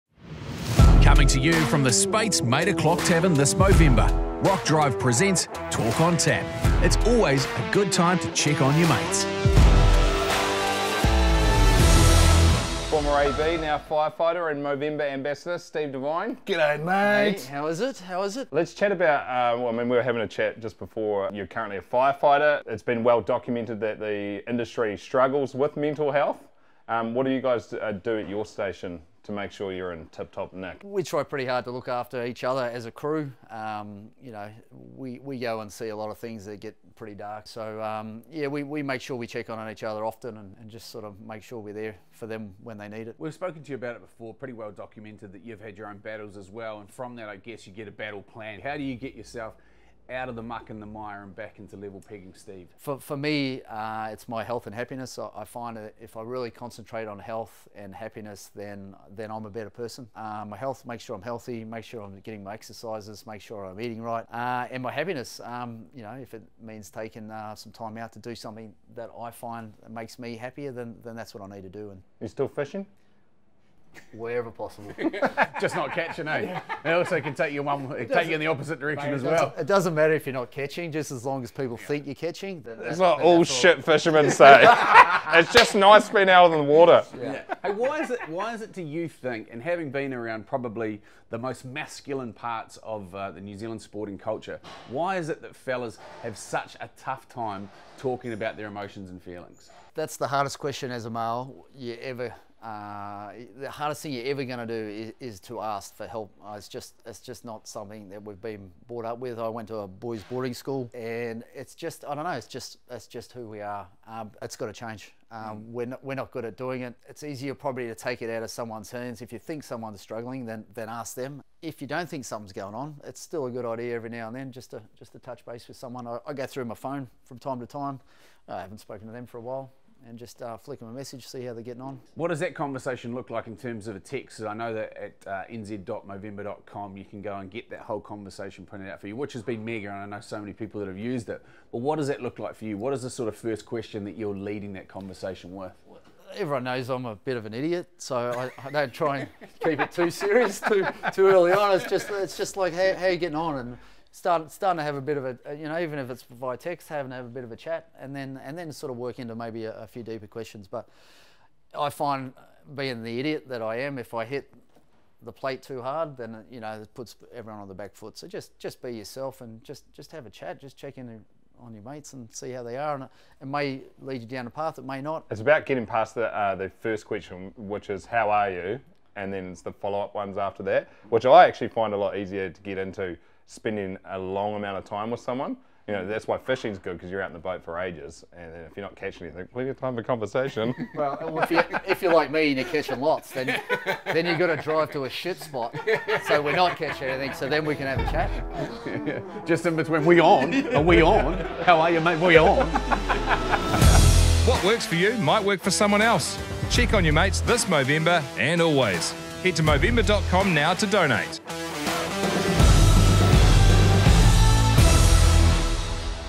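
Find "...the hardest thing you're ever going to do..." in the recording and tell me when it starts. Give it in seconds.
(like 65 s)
103 s.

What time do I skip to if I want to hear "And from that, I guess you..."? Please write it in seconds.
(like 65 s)
46 s.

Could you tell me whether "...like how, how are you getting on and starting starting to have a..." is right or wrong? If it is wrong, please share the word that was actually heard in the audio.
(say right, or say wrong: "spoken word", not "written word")
right.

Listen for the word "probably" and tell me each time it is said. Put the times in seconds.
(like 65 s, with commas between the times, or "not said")
90 s, 117 s.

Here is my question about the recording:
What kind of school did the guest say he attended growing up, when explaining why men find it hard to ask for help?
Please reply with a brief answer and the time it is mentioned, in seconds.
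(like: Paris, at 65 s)
Boys' boarding school, at 109 s.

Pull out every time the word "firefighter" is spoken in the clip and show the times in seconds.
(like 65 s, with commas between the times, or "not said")
13 s, 21 s.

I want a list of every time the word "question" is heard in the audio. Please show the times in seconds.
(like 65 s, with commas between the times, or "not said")
100 s, 143 s, 160 s, 177 s.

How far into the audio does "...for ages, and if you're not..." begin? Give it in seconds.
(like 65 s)
187 s.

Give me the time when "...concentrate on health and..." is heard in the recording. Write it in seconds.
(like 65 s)
56 s.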